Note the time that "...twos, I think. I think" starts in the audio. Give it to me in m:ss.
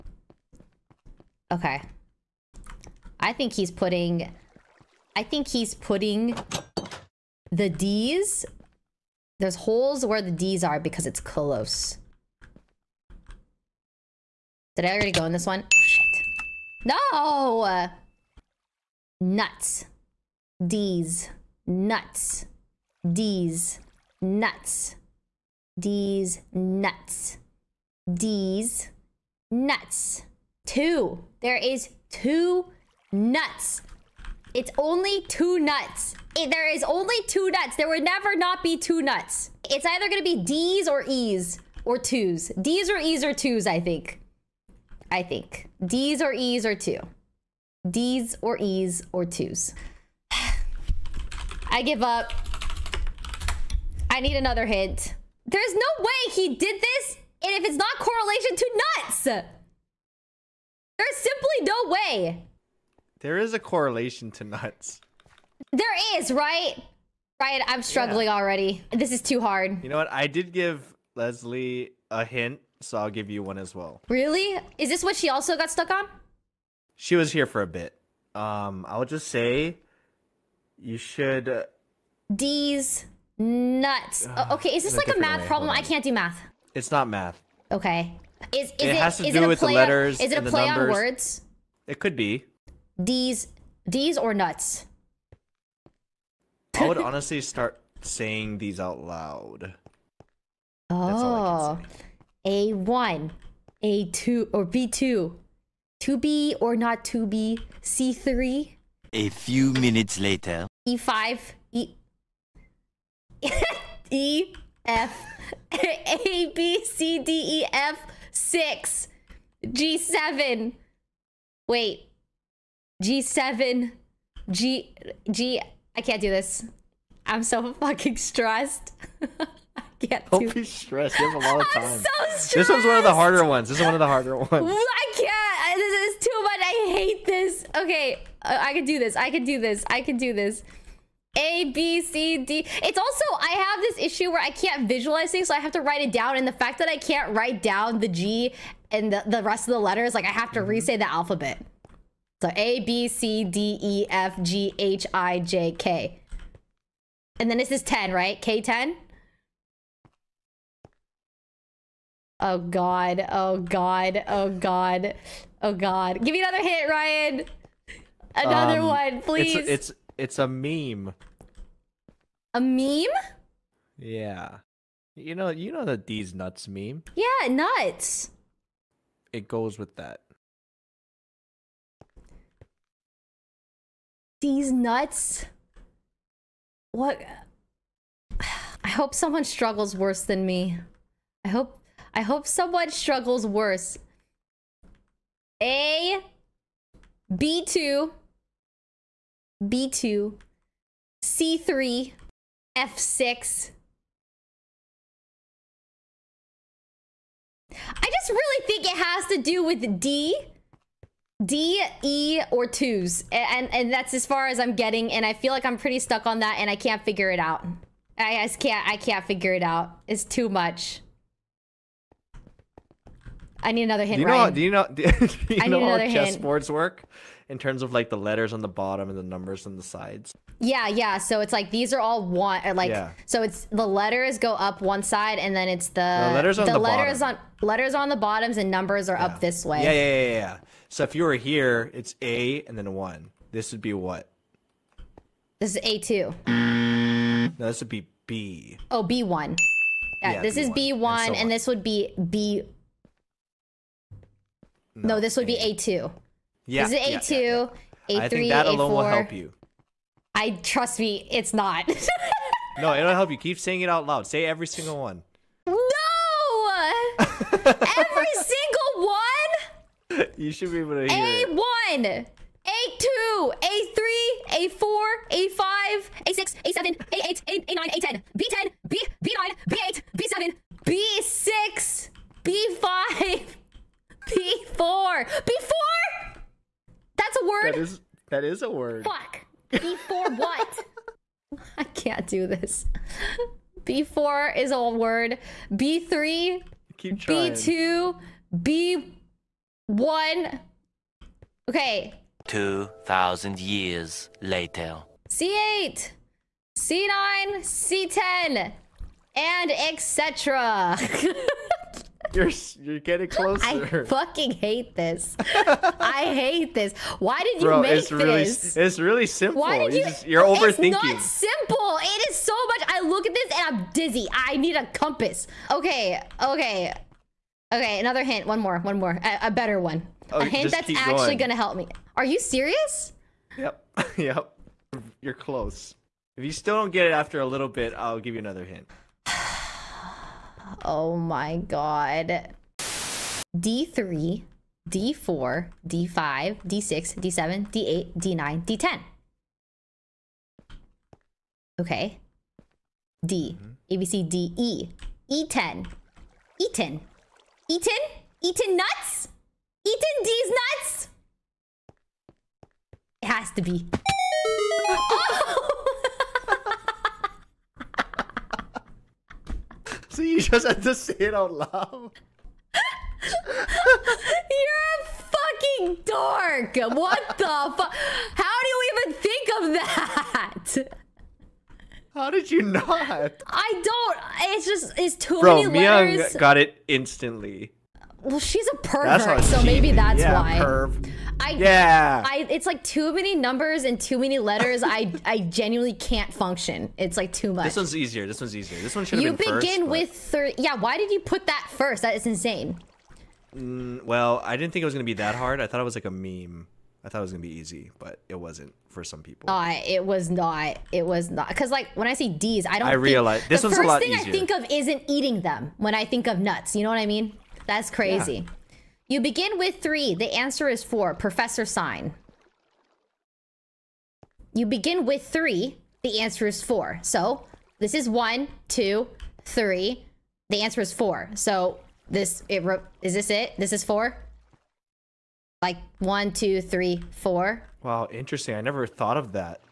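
0:43.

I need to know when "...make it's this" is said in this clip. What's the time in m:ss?
5:17.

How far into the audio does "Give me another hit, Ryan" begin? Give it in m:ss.
2:46.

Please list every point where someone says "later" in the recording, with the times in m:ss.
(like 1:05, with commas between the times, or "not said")
1:50, 5:04.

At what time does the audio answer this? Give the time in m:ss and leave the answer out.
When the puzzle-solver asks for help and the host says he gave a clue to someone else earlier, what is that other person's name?
1:11.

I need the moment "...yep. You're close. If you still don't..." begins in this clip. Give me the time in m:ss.
5:34.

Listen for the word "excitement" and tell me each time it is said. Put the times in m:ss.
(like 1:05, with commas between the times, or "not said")
not said.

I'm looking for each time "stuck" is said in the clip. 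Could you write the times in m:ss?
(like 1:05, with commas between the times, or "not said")
1:15, 3:35.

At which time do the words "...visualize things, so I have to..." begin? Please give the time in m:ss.
2:24.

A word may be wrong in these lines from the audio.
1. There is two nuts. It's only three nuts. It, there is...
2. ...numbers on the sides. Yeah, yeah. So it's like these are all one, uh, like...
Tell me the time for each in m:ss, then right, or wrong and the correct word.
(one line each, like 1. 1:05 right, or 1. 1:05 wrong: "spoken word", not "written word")
1. 0:31 wrong: "two", not "three"
2. 3:49 right.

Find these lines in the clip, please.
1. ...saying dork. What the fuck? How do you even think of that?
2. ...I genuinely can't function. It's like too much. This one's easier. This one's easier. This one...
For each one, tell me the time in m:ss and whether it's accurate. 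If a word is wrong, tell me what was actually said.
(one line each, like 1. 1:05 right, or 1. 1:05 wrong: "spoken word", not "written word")
1. 6:15 wrong: "fucking", not "saying"
2. 6:35 right.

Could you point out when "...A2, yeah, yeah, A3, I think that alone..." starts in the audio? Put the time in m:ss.
4:17.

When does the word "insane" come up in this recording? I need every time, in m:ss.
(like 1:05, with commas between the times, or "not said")
6:42.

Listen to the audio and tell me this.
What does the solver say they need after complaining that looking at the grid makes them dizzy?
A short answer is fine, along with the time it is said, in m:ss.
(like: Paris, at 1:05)
a compass, at 5:24.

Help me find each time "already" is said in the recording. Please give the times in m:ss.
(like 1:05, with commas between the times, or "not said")
0:14, 1:08.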